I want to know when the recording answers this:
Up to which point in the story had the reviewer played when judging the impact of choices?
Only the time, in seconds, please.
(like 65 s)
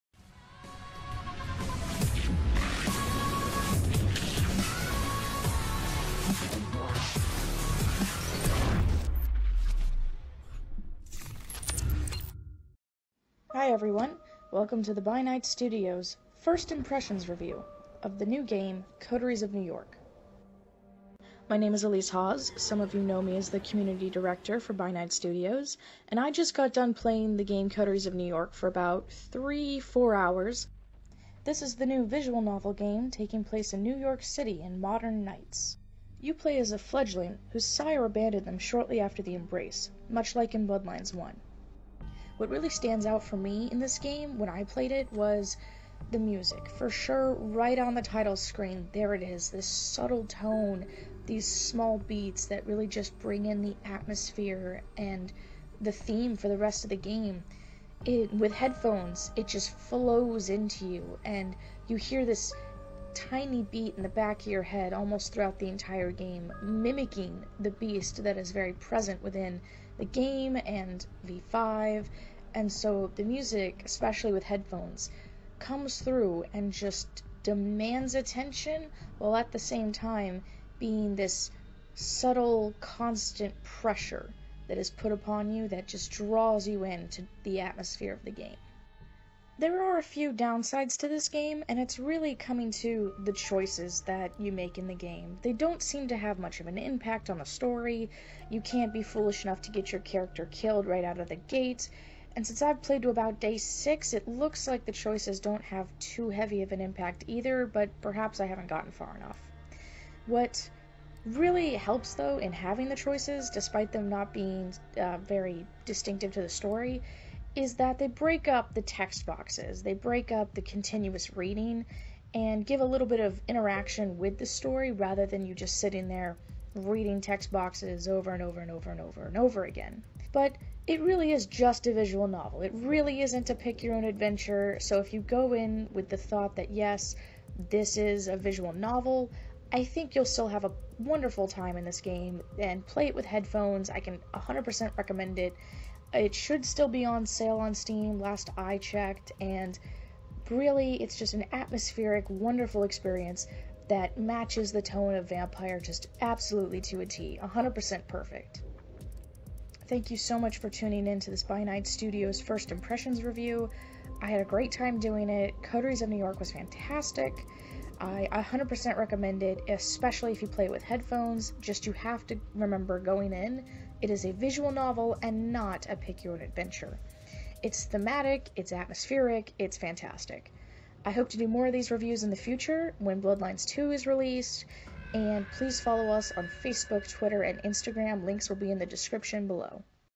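103 s.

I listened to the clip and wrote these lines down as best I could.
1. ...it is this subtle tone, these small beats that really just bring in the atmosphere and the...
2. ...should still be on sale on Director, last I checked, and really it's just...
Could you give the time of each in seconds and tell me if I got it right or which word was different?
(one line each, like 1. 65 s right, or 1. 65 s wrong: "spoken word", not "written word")
1. 49 s right
2. 146 s wrong: "Steam", not "Director".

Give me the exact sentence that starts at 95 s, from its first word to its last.
They don't seem to have much of an impact on the story.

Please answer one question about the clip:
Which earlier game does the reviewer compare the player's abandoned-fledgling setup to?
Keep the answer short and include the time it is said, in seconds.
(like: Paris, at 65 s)
Bloodlines 1, at 40 s.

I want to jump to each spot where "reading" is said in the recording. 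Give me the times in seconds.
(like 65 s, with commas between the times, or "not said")
121 s, 126 s.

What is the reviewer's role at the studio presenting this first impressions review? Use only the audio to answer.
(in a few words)
Community Director.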